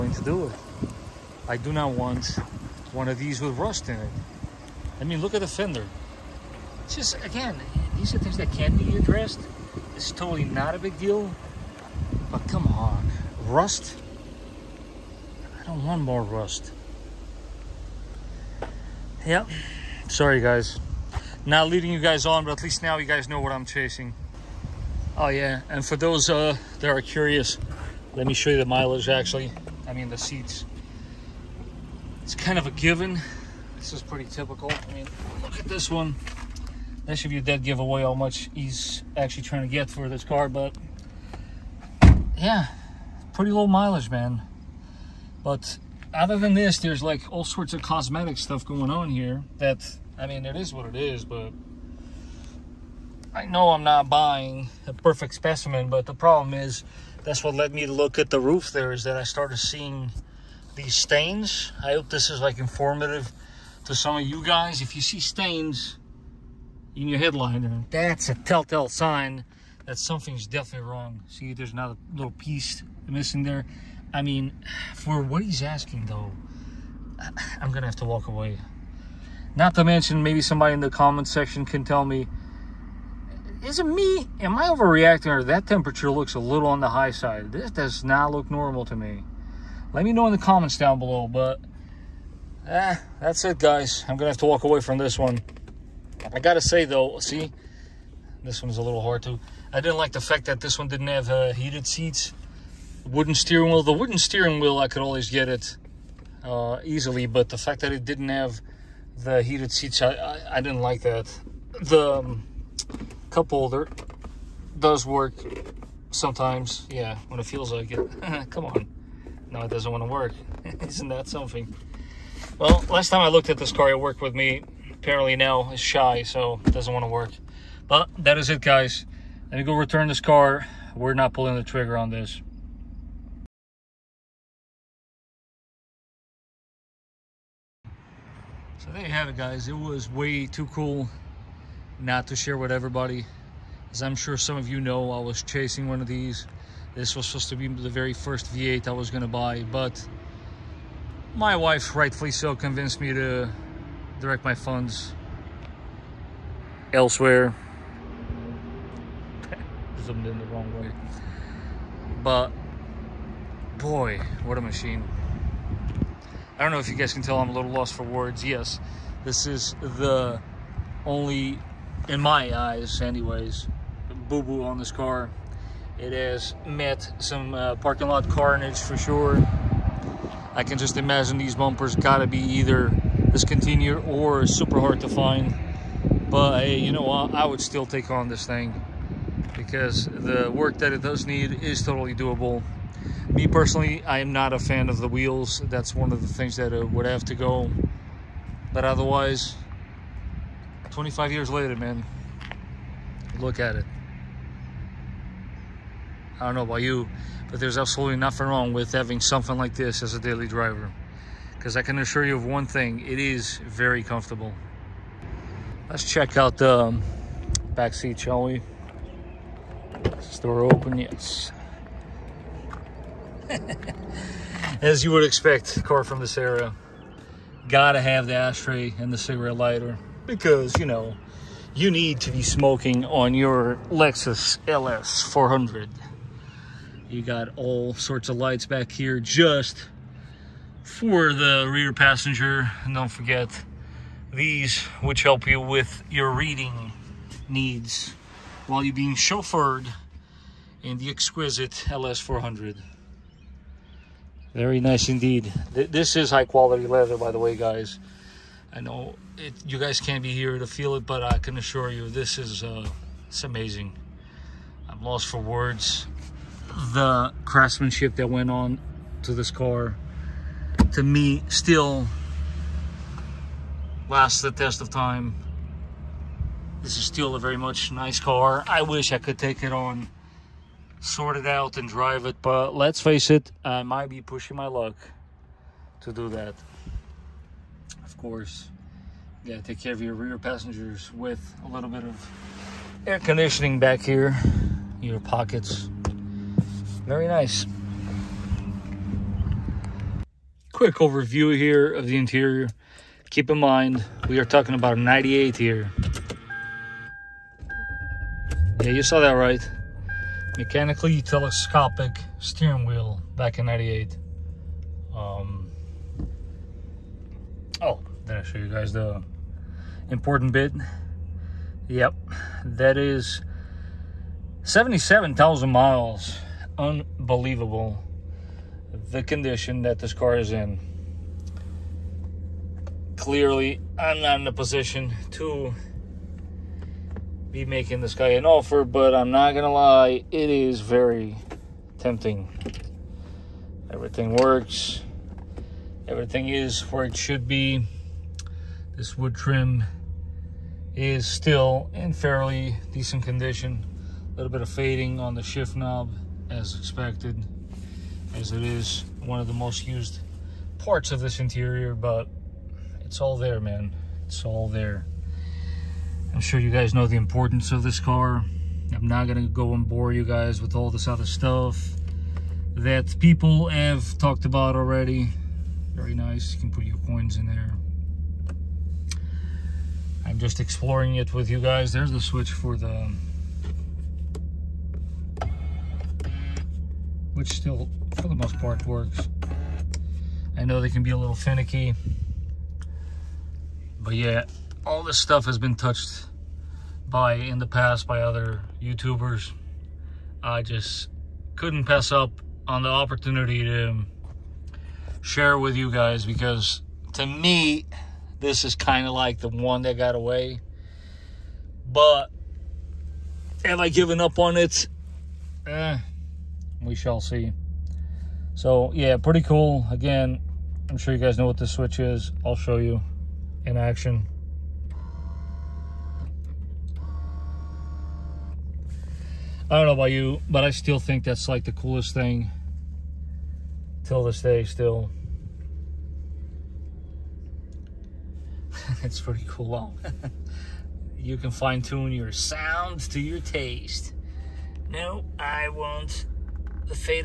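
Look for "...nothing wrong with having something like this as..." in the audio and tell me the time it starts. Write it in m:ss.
3:28.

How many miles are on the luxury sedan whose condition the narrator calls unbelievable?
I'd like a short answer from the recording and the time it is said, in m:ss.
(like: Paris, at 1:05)
77,000, at 5:24.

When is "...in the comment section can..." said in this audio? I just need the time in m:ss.
1:20.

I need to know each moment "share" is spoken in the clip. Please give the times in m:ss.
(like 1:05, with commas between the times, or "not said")
2:22, 6:45.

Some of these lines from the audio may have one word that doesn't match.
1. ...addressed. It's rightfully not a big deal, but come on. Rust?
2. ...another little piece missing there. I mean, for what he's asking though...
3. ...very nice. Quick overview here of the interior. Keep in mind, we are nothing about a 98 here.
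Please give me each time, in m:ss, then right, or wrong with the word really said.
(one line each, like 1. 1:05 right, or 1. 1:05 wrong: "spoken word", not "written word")
1. 0:08 wrong: "totally", not "rightfully"
2. 1:11 right
3. 4:57 wrong: "talking", not "nothing".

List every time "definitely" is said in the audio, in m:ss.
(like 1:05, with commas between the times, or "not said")
1:10.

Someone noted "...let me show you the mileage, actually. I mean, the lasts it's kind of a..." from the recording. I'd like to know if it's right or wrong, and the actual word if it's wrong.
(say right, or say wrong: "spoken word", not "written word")
wrong: "seats", not "lasts".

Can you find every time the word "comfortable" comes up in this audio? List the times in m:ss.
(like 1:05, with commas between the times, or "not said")
3:34.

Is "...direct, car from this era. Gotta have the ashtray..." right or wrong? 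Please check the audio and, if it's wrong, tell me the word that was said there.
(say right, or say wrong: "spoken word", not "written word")
wrong: "expect", not "direct".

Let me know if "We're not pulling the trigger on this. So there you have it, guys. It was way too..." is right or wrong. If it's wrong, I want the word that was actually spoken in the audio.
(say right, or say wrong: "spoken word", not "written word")
right.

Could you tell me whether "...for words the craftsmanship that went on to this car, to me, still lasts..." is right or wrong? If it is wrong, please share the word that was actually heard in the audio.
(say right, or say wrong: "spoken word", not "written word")
right.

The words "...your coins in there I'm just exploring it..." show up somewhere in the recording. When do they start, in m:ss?
6:16.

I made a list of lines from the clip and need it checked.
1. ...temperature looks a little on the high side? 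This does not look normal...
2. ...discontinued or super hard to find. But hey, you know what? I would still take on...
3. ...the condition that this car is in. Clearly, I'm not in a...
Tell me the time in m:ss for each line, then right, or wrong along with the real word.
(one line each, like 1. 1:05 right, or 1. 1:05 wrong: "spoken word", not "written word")
1. 1:25 right
2. 3:03 right
3. 5:29 right.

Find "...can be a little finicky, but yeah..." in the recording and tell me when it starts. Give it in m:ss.
6:30.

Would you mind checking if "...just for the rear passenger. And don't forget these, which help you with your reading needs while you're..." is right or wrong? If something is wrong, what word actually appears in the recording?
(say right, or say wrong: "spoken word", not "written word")
right.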